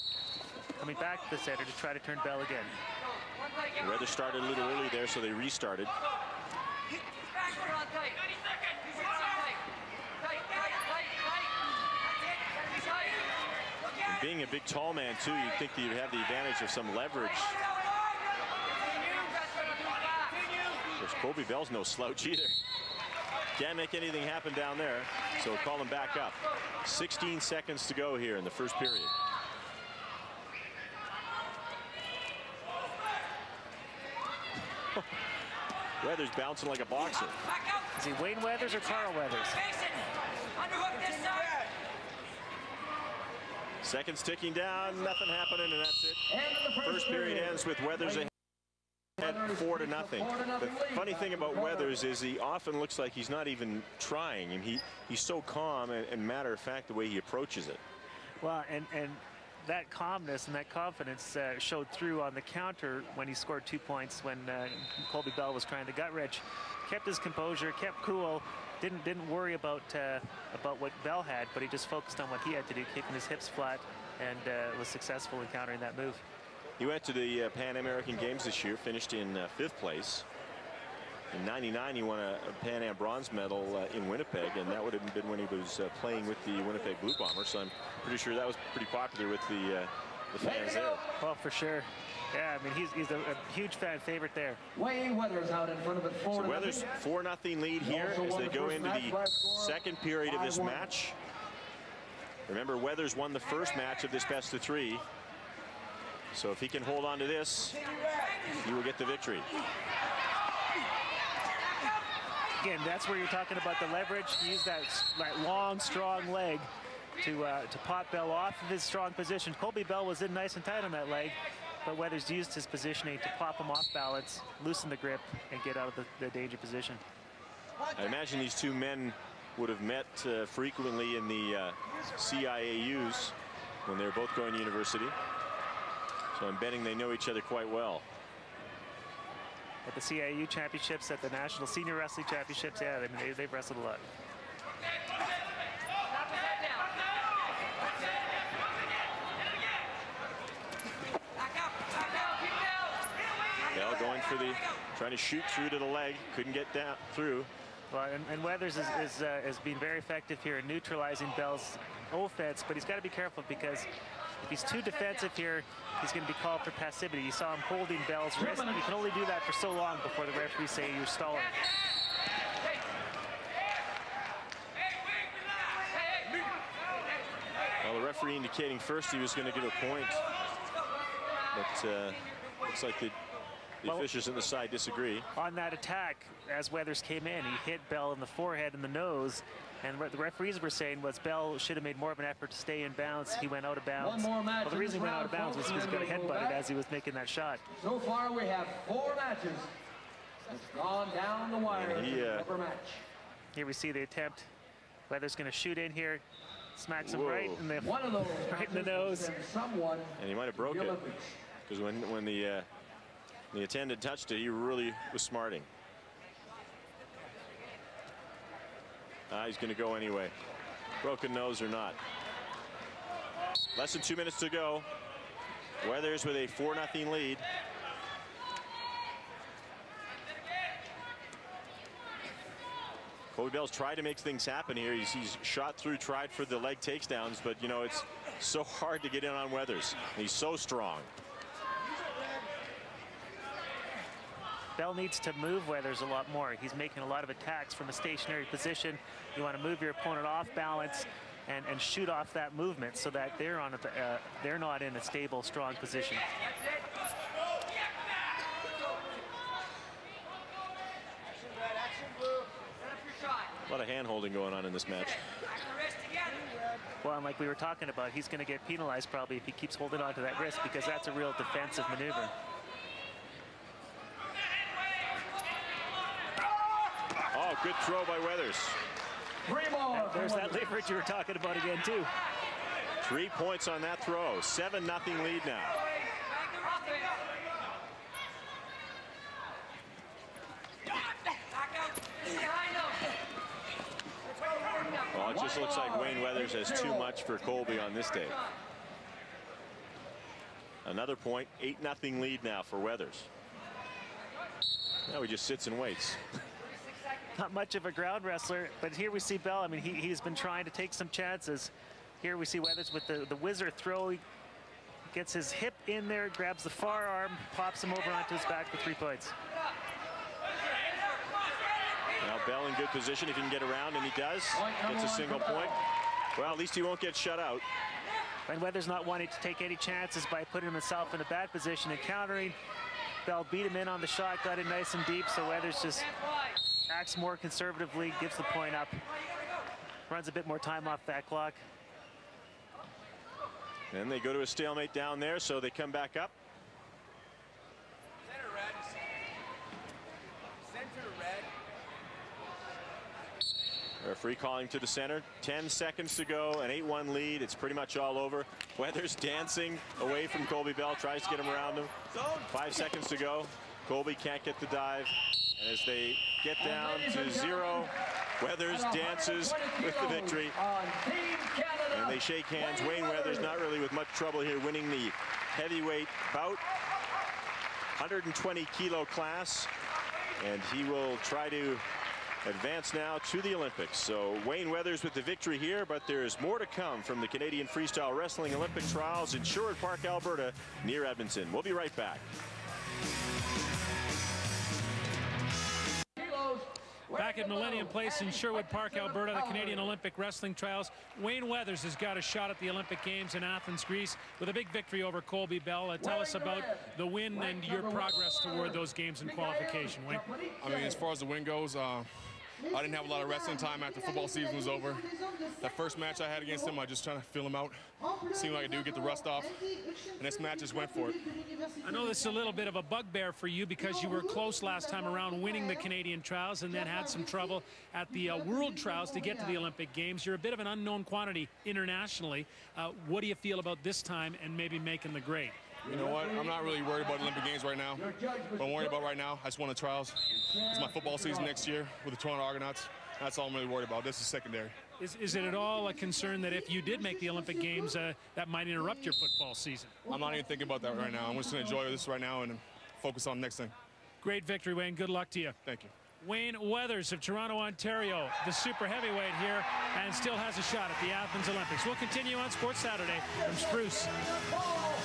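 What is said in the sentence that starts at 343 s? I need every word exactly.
And they go to a stalemate down there, so they come back up.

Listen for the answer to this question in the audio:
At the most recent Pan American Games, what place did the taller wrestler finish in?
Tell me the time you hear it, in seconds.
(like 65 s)
79 s.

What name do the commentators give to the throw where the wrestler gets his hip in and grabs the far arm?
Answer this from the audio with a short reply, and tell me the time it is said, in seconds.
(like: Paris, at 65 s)
Wizard throw, at 313 s.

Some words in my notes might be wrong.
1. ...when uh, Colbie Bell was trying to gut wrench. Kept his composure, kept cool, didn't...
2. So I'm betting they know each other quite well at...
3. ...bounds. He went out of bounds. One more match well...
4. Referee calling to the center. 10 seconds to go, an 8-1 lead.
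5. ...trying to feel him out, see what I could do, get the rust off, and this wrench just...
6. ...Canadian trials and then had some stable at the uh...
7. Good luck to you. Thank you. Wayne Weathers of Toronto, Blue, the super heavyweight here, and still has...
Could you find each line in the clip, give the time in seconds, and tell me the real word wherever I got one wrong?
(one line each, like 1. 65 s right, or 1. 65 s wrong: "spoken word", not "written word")
1. 64 s right
2. 136 s right
3. 192 s right
4. 354 s right
5. 417 s wrong: "match", not "wrench"
6. 425 s wrong: "trouble", not "stable"
7. 454 s wrong: "Ontario", not "Blue".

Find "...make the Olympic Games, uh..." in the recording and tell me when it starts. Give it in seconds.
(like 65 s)
447 s.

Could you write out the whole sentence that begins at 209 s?
And he might have broke it because when when the uh, the attendant touched it.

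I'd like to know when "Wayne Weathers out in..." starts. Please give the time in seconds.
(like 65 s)
94 s.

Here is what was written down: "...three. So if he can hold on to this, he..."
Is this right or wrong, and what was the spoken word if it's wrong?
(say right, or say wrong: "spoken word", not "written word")
right.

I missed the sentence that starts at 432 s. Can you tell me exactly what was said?
Uh, what do you feel about this time and maybe making the grade?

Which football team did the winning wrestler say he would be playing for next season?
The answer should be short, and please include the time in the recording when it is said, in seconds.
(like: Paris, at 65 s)
Toronto Argonauts, at 442 s.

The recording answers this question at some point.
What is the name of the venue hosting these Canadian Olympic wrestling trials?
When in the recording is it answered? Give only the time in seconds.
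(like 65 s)
397 s.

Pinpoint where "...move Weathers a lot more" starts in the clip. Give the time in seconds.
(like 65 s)
245 s.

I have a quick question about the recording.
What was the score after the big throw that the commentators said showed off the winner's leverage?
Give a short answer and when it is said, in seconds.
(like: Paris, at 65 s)
7-0, at 284 s.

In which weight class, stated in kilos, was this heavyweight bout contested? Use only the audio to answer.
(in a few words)
120 kilo.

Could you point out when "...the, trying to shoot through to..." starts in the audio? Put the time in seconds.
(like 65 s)
154 s.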